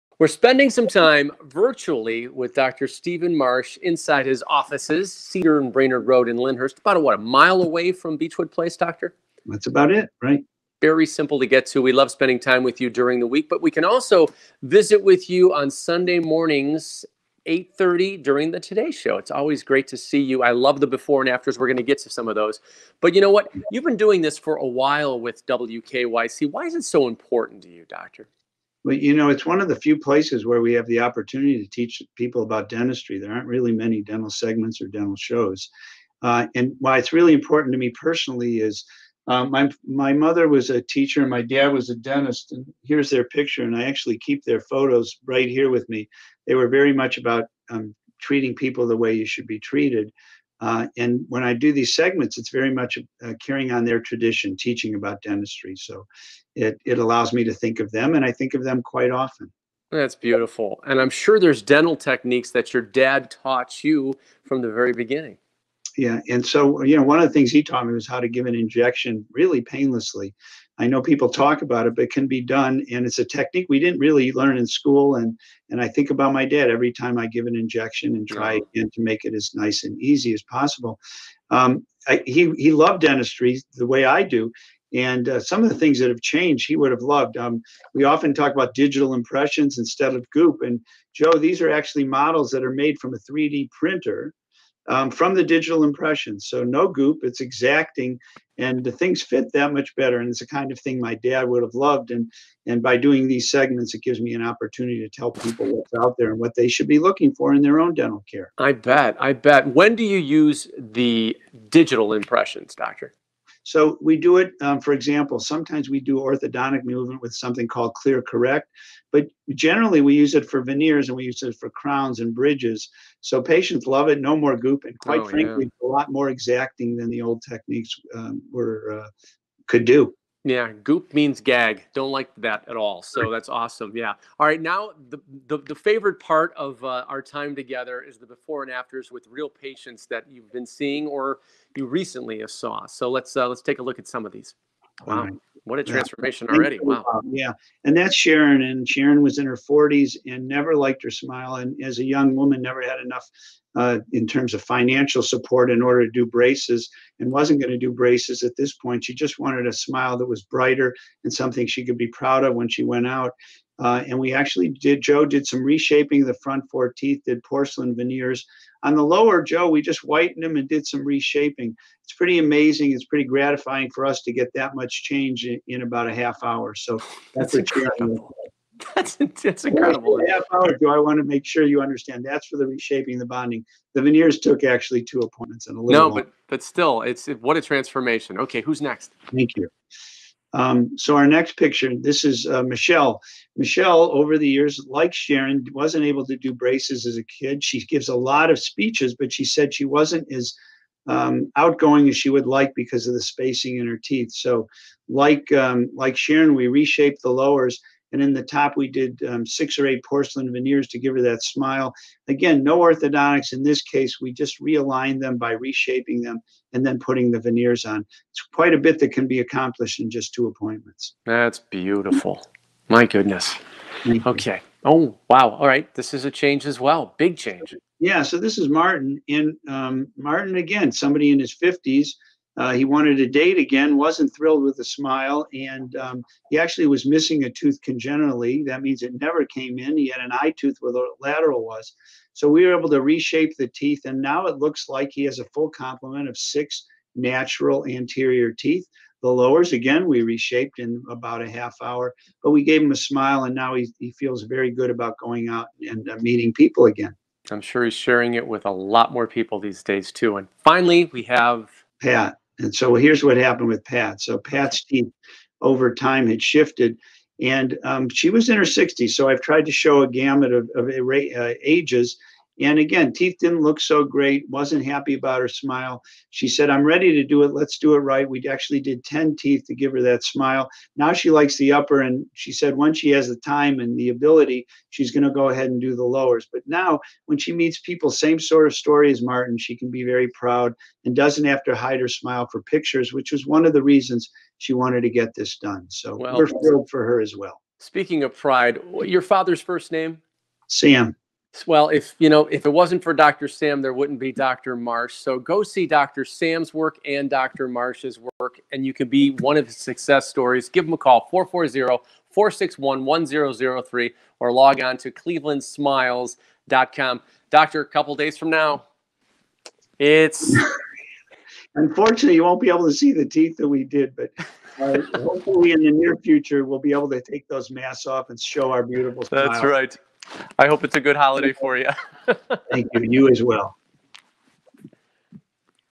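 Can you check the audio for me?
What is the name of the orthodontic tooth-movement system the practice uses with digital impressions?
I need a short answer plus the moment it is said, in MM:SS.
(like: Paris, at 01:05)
ClearCorrect, at 01:58.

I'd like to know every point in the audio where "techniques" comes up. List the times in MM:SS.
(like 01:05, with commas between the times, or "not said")
01:01, 01:13, 02:07.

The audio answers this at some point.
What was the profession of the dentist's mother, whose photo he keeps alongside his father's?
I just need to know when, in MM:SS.
00:40.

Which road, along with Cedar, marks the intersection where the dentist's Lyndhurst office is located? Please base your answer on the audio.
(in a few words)
Brainard Road.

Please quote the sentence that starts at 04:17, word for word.
I'm sure he's sharing it with a lot more people these days, too.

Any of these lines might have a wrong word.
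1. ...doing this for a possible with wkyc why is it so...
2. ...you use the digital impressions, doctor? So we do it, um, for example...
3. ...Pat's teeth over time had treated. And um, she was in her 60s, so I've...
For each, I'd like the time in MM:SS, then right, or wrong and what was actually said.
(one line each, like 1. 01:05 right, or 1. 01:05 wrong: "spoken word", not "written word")
1. 00:23 wrong: "while", not "possible"
2. 01:50 right
3. 04:24 wrong: "shifted", not "treated".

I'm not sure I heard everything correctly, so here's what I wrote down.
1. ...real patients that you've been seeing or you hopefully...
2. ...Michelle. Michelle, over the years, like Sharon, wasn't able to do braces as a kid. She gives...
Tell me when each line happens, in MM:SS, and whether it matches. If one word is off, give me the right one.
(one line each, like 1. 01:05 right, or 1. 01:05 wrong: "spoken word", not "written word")
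1. 02:19 wrong: "recently", not "hopefully"
2. 03:12 right.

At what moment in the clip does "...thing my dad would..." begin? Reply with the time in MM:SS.
01:40.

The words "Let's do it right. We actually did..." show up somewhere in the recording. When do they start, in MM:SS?
04:37.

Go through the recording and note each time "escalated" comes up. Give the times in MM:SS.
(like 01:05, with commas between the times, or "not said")
not said.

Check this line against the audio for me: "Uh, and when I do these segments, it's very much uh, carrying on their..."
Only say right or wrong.
right.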